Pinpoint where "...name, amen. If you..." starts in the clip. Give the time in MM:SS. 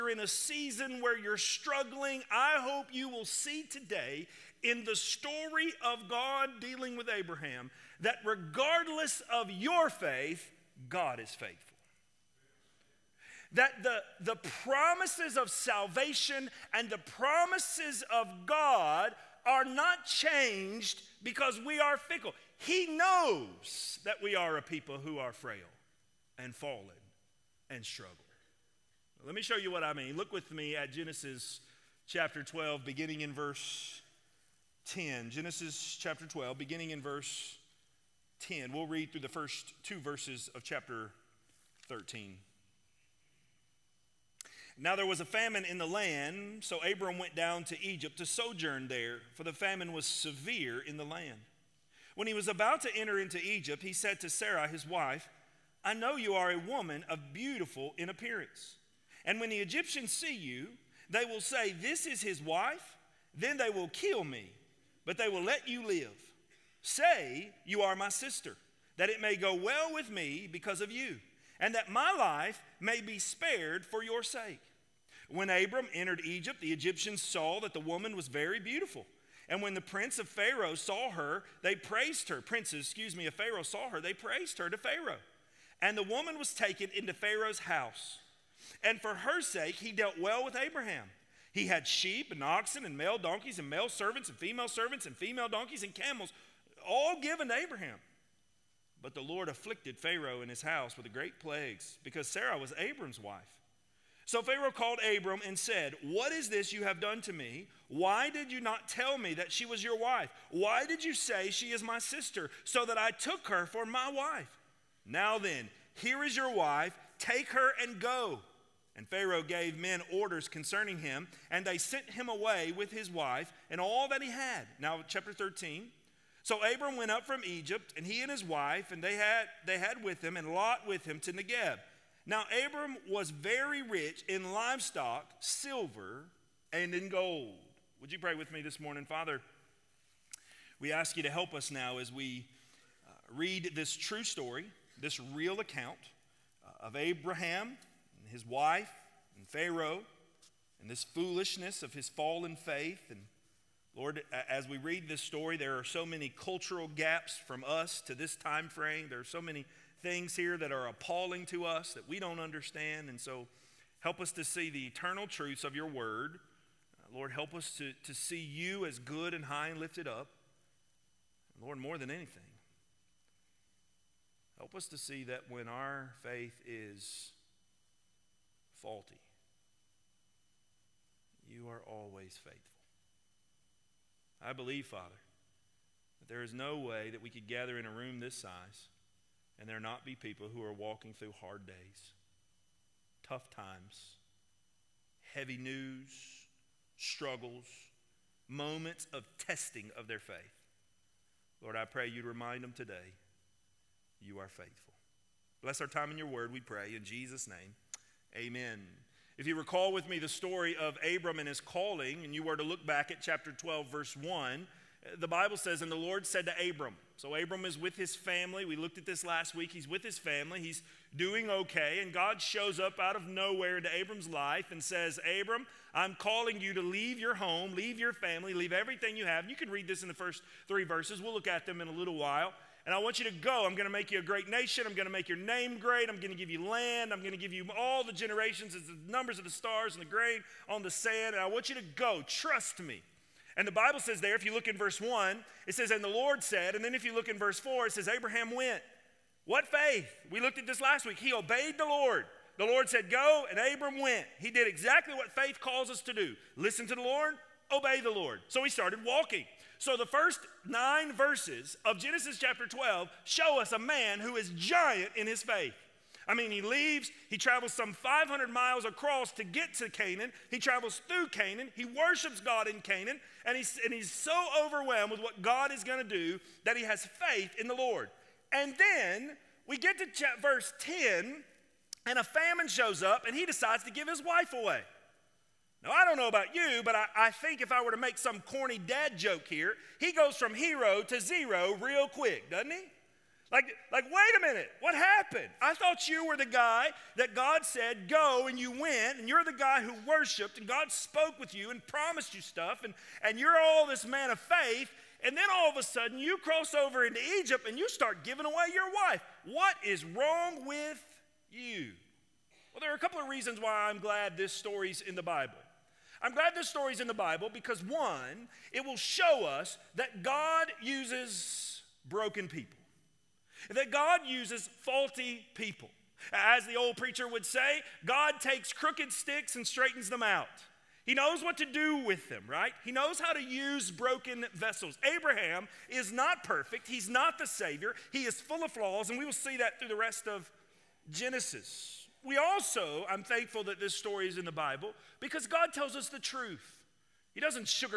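03:27.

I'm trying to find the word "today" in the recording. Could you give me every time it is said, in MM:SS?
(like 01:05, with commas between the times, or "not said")
00:03, 03:22.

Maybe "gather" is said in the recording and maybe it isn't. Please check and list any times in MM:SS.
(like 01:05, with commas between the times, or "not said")
03:07.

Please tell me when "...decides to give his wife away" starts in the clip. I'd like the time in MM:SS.
04:43.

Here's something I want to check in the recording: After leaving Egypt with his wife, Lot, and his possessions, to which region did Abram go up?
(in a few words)
Negeb.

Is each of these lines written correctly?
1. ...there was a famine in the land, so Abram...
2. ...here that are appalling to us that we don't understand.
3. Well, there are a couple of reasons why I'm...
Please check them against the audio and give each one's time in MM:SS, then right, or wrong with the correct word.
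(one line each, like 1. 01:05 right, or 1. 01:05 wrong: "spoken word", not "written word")
1. 00:44 right
2. 02:40 right
3. 05:12 right.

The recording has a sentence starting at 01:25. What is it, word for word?
And the woman was taken into Pharaoh's house.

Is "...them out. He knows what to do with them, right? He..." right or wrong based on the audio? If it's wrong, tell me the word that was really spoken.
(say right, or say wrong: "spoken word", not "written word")
right.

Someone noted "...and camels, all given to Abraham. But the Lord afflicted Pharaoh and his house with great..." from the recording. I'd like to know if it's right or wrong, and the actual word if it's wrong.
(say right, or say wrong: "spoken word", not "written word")
right.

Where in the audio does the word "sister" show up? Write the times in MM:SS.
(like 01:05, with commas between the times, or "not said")
01:08, 01:51.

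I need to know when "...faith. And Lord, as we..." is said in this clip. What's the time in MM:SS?
02:32.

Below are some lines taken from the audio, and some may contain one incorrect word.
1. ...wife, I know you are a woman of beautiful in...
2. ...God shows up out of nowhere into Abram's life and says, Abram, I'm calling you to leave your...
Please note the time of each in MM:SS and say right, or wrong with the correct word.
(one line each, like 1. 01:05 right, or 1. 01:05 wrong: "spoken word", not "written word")
1. 00:54 right
2. 03:42 right.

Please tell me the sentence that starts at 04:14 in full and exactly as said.
He did exactly what faith calls us to do listen to the Lord, obey the Lord.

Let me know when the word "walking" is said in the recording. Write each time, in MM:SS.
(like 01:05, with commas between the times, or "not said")
03:10, 04:19.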